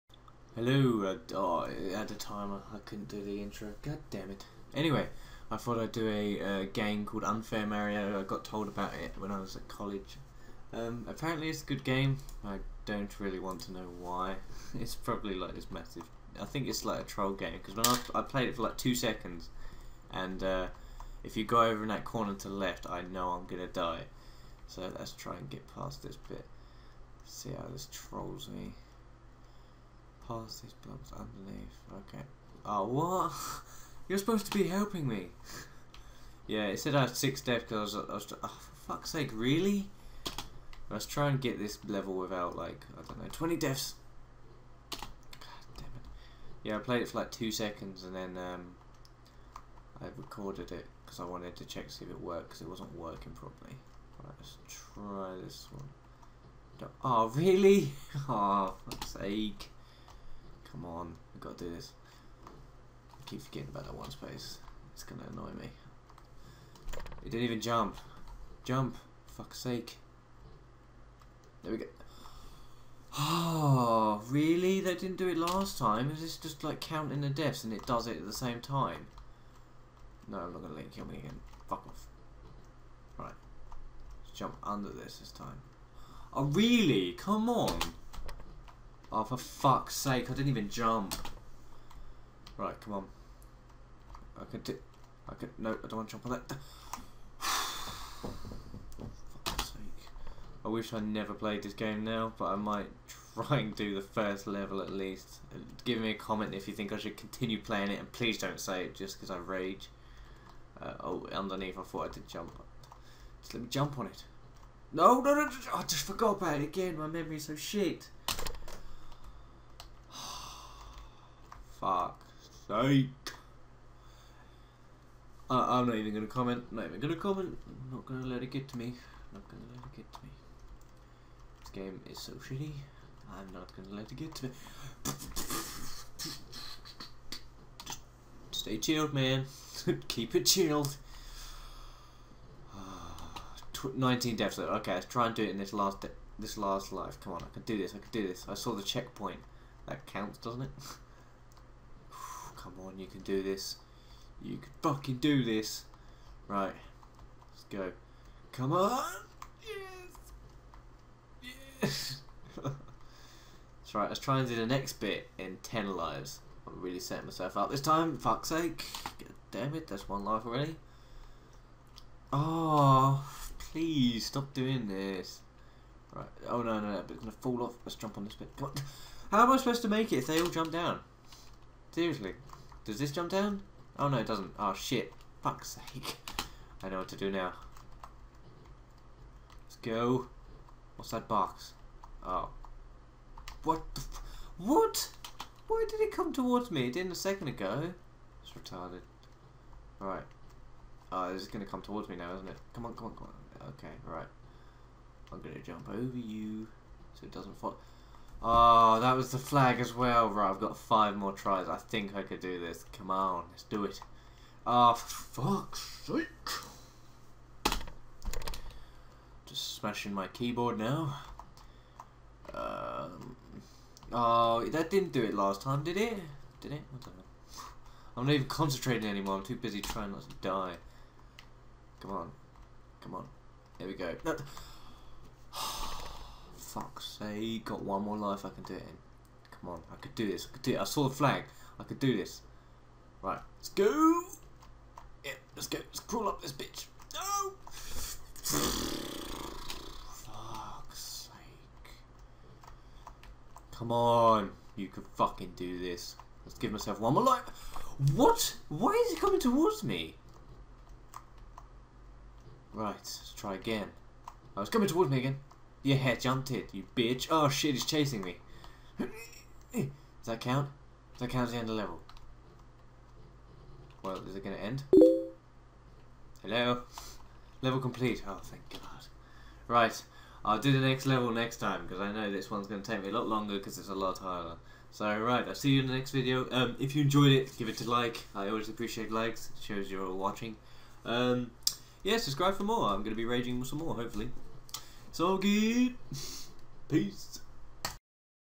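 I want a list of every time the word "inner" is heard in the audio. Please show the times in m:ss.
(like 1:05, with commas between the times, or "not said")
not said.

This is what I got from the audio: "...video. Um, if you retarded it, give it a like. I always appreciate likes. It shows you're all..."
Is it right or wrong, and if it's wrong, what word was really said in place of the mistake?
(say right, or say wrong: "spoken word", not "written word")
wrong: "enjoyed", not "retarded".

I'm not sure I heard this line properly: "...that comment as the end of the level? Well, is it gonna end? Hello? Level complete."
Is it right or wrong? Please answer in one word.
wrong.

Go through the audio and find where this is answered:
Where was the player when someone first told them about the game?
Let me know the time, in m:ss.
0:09.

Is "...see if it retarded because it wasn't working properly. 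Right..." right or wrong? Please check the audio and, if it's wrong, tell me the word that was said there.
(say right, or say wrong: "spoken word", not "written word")
wrong: "worked", not "retarded".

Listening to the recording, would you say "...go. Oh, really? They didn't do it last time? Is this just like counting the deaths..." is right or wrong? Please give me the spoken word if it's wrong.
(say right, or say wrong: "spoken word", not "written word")
right.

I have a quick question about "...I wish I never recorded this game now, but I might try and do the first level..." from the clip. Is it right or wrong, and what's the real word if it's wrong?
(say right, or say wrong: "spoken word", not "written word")
wrong: "played", not "recorded".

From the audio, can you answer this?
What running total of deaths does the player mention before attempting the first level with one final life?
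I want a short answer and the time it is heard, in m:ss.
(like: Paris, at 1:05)
19, at 2:23.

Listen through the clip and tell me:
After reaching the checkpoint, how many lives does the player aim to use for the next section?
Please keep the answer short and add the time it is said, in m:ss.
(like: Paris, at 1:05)
10, at 2:45.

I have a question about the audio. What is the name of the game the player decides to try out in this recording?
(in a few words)
Unfair Mario.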